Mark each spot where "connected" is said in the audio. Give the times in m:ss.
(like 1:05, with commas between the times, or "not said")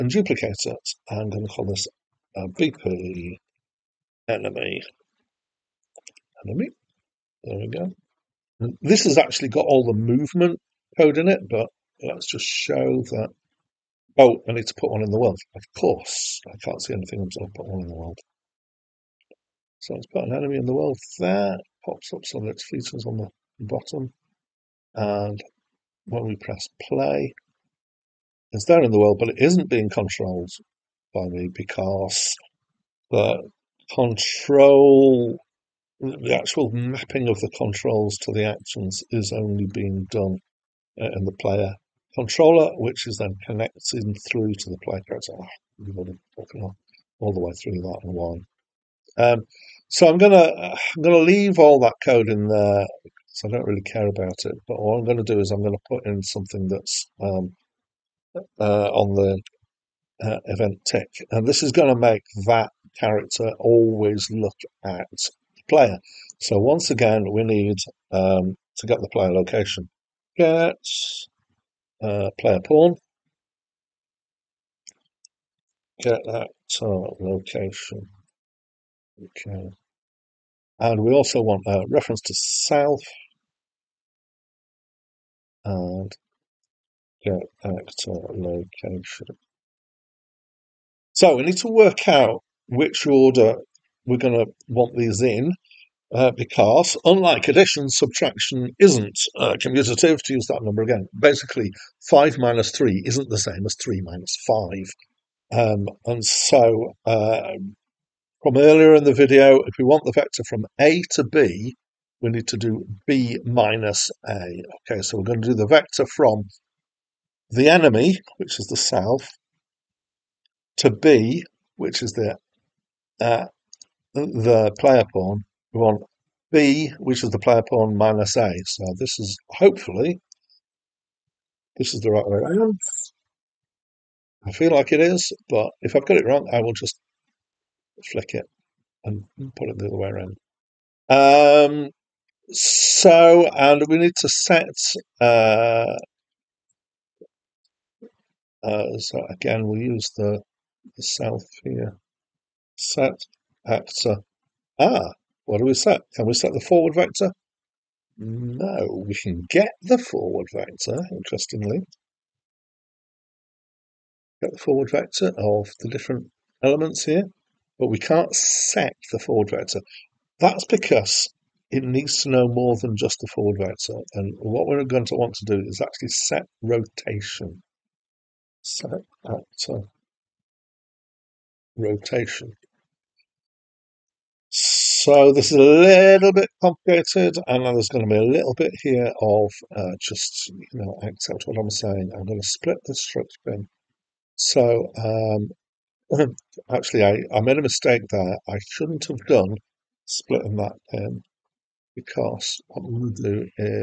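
0:43.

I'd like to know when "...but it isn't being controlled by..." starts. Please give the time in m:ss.
0:29.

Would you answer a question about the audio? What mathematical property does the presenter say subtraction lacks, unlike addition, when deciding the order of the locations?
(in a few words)
Commutative.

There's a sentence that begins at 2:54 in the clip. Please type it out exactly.
And what we're going to want to do is actually set rotation.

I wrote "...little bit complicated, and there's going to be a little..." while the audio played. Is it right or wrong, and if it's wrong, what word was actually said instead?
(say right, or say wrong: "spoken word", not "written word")
right.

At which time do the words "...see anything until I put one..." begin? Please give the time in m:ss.
0:16.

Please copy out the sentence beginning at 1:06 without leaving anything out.
So once again, we need um, to get the player location.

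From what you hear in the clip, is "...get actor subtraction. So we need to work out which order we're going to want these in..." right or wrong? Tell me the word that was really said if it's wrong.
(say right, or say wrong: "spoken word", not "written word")
wrong: "location", not "subtraction".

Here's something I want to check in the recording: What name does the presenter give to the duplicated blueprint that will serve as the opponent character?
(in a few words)
BP enemy.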